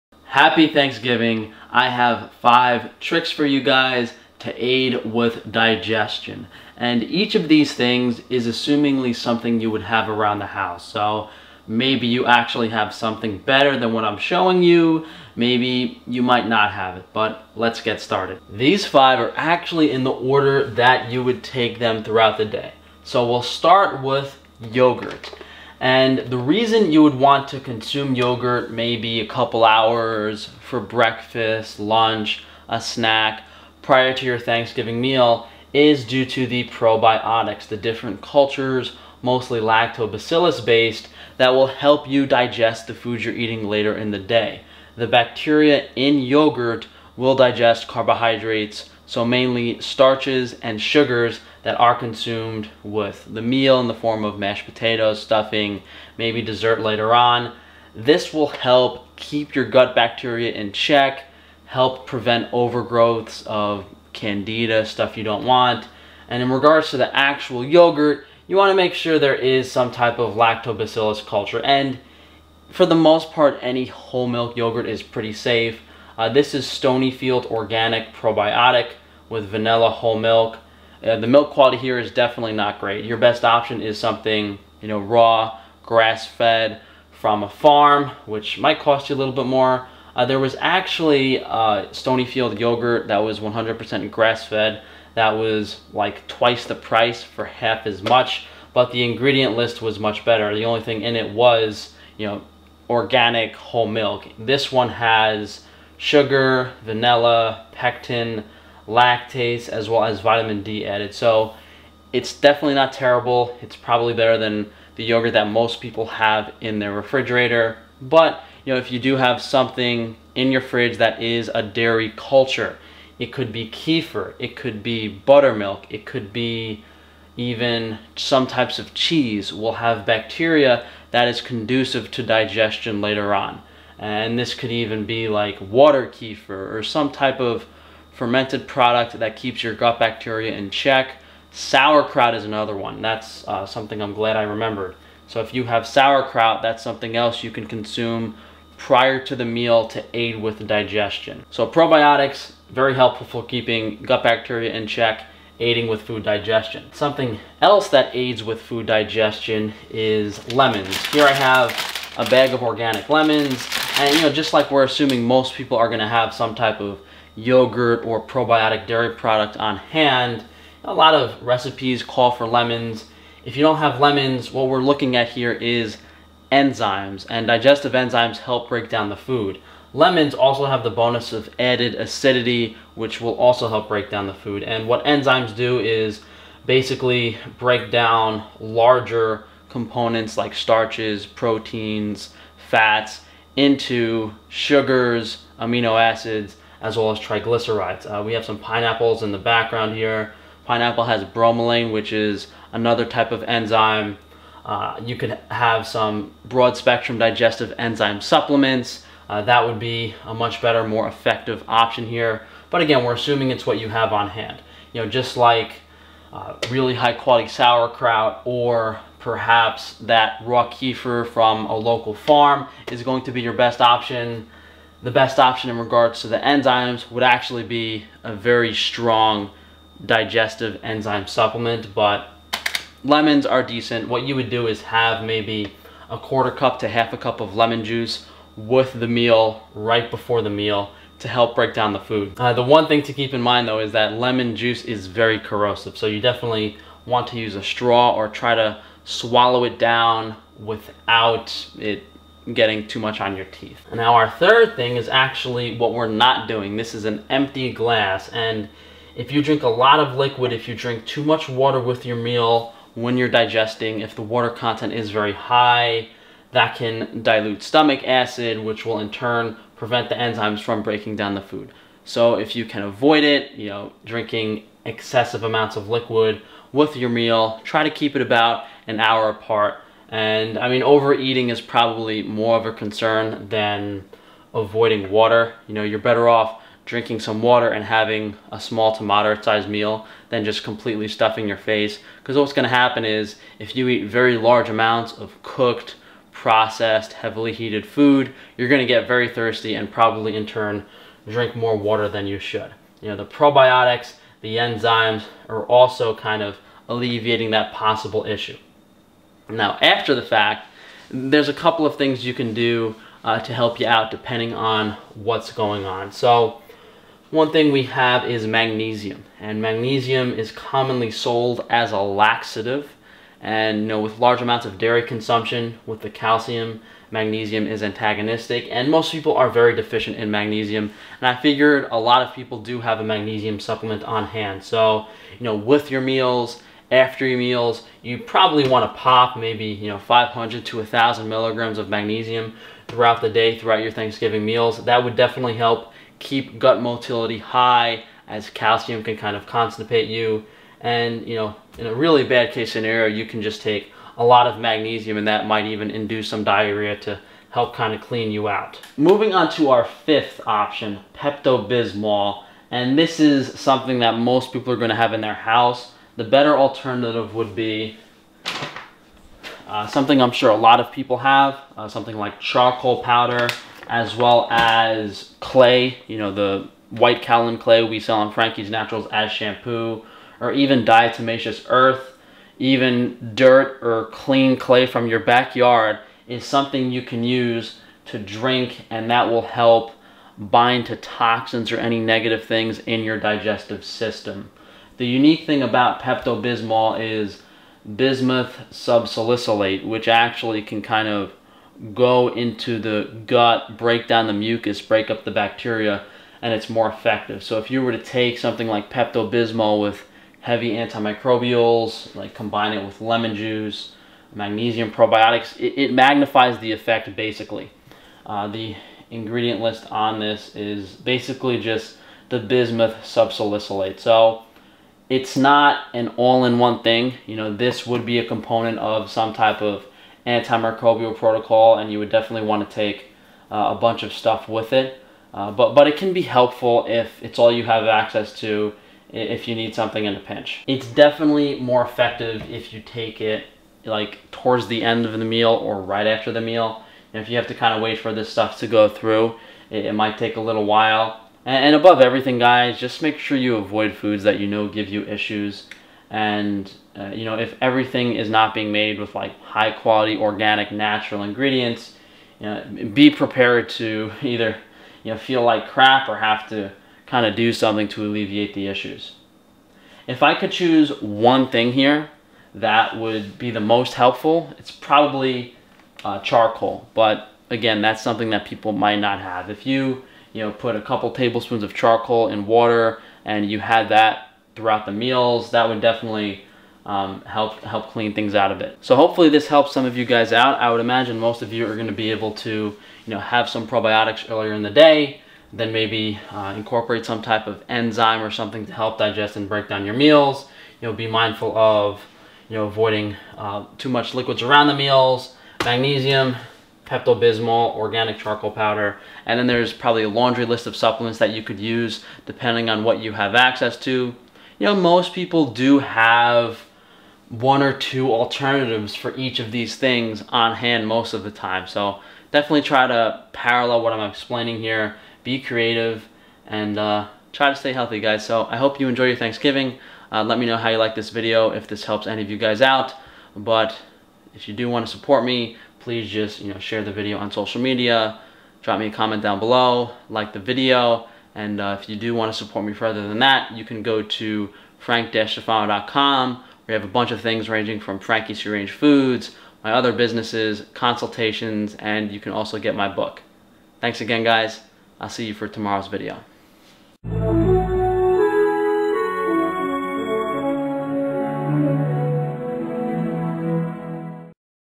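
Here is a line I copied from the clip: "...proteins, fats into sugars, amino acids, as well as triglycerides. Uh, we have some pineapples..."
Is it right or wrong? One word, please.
right.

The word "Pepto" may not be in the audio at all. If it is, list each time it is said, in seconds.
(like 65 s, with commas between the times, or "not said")
361 s, 396 s, 408 s, 506 s.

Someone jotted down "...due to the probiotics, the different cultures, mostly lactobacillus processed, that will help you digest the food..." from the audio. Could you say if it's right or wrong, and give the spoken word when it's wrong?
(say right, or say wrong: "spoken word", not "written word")
wrong: "based", not "processed".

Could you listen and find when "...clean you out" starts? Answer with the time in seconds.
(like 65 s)
358 s.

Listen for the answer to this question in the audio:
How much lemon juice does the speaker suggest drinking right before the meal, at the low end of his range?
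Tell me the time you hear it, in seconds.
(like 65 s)
236 s.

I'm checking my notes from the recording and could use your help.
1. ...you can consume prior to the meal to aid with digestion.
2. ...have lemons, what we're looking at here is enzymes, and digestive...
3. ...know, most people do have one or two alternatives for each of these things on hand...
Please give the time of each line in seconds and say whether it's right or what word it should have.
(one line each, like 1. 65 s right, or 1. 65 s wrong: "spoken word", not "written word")
1. 147 s right
2. 173 s right
3. 514 s right.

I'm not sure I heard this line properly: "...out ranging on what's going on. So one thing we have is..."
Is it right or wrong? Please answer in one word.
wrong.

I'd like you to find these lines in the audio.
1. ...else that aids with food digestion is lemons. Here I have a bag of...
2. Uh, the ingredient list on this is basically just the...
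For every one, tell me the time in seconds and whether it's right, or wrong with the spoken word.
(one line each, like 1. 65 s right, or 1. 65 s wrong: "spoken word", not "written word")
1. 157 s right
2. 418 s right.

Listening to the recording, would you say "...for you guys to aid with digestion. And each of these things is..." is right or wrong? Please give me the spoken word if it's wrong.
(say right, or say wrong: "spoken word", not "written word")
right.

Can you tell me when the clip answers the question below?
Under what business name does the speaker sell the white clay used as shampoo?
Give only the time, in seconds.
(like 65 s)
378 s.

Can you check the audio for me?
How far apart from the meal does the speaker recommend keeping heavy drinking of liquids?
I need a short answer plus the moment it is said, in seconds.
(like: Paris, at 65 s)
About an hour, at 278 s.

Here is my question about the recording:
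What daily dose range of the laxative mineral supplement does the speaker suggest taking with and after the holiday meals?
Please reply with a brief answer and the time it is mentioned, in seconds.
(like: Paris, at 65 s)
500 to 1,000 milligrams, at 339 s.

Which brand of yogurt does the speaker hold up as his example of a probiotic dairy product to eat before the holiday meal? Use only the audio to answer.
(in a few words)
Stonyfield Organic.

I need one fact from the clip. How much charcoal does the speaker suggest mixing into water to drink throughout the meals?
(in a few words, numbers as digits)
A couple tablespoons.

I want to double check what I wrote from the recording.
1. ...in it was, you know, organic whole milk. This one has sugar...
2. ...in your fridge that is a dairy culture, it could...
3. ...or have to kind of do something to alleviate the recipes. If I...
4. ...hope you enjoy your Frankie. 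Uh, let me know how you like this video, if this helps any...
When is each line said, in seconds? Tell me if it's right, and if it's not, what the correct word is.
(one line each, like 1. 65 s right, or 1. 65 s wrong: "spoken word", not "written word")
1. 101 s right
2. 120 s right
3. 466 s wrong: "issues", not "recipes"
4. 528 s wrong: "Thanksgiving", not "Frankie".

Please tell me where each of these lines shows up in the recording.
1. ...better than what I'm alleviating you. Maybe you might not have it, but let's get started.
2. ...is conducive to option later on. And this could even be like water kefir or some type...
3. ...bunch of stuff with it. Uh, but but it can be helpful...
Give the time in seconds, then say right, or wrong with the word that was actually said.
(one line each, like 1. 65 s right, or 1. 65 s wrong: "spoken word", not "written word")
1. 13 s wrong: "showing", not "alleviating"
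2. 131 s wrong: "digestion", not "option"
3. 433 s right.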